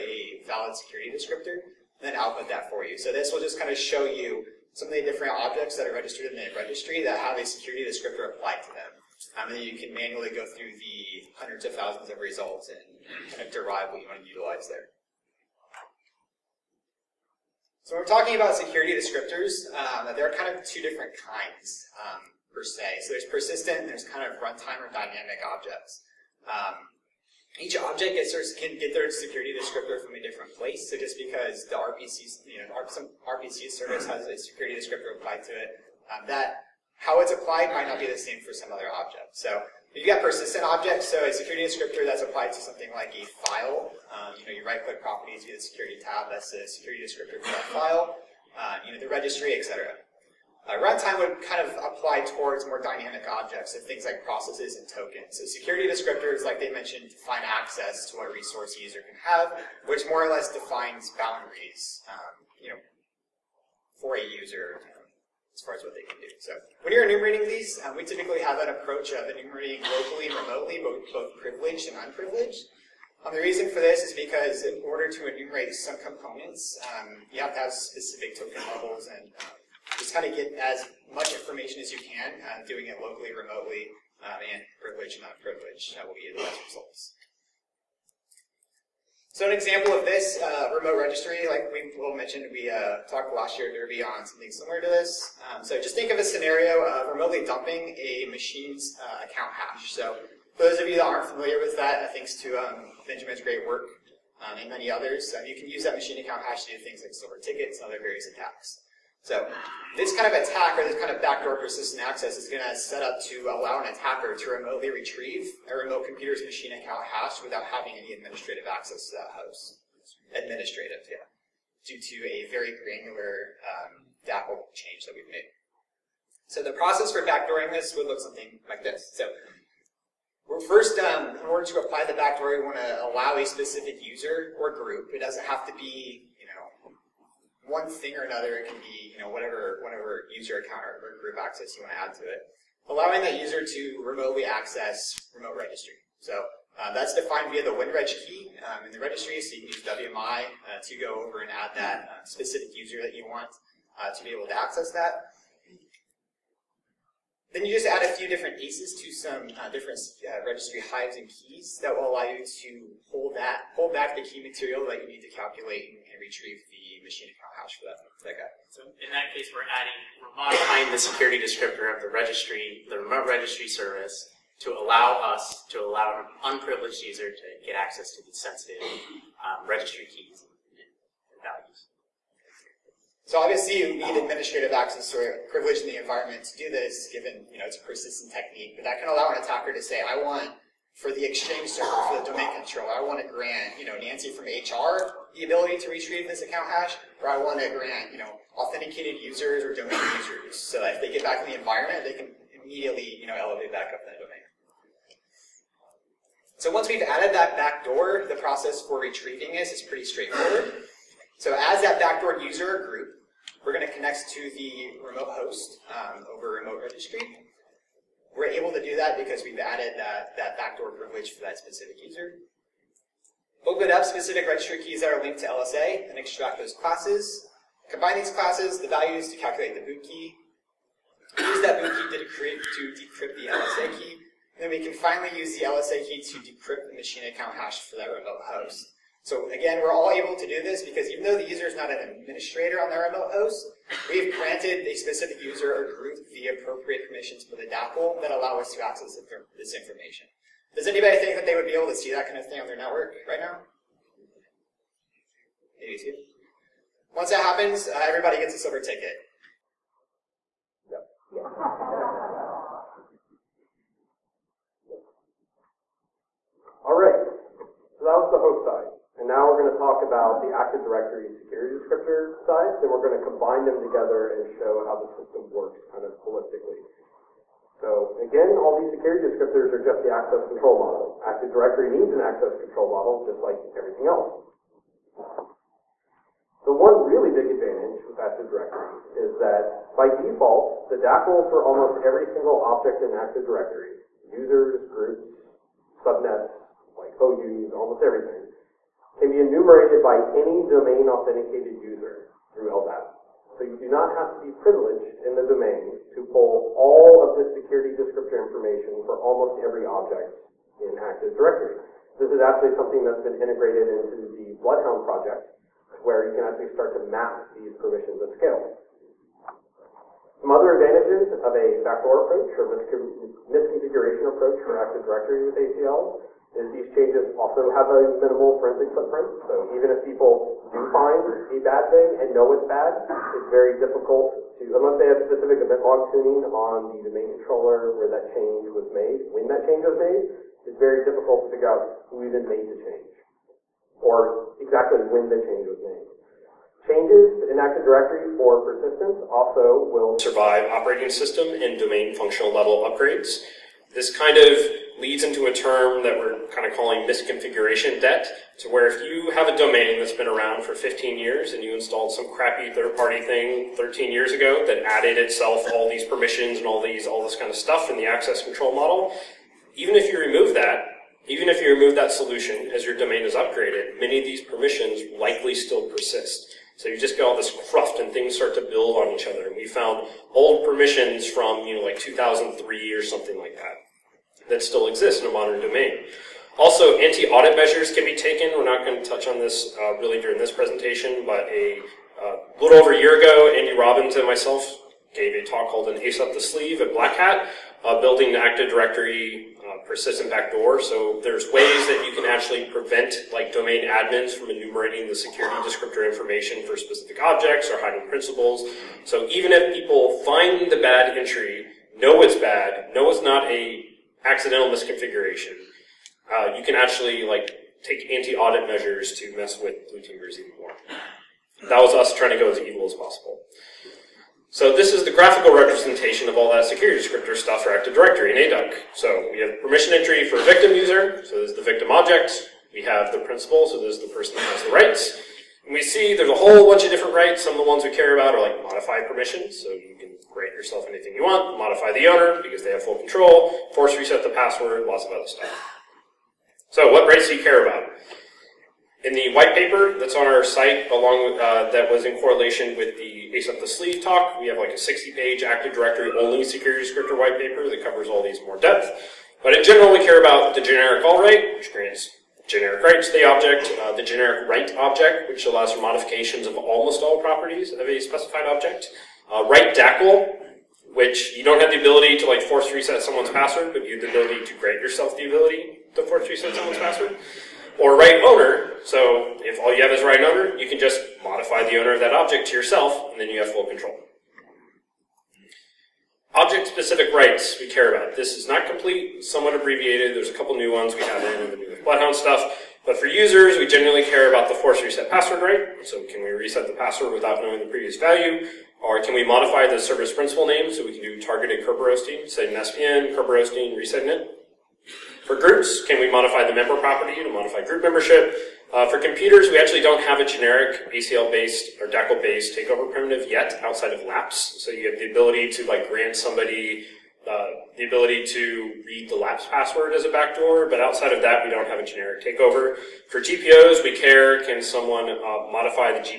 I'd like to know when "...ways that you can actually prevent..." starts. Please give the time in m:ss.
6:41.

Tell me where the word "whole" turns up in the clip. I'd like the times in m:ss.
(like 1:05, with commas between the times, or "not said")
7:16.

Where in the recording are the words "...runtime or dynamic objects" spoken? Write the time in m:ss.
0:24.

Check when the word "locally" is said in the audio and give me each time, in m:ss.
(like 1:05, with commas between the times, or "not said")
1:09, 1:23.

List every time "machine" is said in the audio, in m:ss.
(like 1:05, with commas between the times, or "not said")
1:38, 1:45, 1:56, 2:47, 3:56.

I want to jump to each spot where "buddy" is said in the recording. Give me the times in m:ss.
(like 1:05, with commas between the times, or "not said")
not said.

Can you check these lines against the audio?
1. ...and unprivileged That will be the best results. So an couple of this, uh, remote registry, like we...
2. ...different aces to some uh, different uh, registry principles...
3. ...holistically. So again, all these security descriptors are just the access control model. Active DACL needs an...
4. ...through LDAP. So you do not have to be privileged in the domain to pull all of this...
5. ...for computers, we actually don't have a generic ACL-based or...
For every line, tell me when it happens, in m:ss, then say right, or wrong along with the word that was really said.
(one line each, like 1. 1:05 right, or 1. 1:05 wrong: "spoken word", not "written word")
1. 1:25 wrong: "example", not "couple"
2. 2:38 wrong: "hives", not "principles"
3. 4:36 wrong: "Directory", not "DACL"
4. 5:02 right
5. 8:28 right.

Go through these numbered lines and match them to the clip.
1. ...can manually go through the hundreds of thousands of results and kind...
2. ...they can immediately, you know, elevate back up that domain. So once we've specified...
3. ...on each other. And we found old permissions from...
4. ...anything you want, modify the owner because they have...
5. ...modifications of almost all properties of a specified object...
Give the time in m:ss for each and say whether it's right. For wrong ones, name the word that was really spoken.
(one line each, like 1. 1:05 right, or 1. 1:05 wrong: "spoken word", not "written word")
1. 0:09 right
2. 3:22 wrong: "added", not "specified"
3. 6:18 right
4. 7:20 right
5. 7:45 right.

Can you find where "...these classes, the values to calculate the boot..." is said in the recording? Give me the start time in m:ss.
3:48.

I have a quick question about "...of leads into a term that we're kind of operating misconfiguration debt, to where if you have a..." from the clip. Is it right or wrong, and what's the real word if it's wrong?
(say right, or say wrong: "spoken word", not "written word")
wrong: "calling", not "operating".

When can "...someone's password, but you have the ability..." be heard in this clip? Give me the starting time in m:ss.
7:53.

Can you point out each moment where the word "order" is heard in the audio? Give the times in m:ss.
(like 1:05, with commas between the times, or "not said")
1:14, 2:11.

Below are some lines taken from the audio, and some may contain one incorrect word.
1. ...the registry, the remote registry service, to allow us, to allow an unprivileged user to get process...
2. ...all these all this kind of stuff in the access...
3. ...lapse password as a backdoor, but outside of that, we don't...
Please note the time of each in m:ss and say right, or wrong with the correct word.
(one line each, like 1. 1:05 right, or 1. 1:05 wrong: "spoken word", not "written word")
1. 2:52 wrong: "access", not "process"
2. 6:06 right
3. 8:39 right.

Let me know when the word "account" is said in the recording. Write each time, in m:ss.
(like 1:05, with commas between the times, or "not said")
1:39, 1:46, 1:56, 2:20, 2:47, 3:16, 3:57.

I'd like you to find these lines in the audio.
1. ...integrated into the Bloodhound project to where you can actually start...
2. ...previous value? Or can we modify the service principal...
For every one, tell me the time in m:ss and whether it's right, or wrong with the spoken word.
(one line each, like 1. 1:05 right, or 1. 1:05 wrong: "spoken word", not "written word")
1. 5:13 right
2. 8:17 right.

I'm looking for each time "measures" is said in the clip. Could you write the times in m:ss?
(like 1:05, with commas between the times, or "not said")
6:27, 6:58.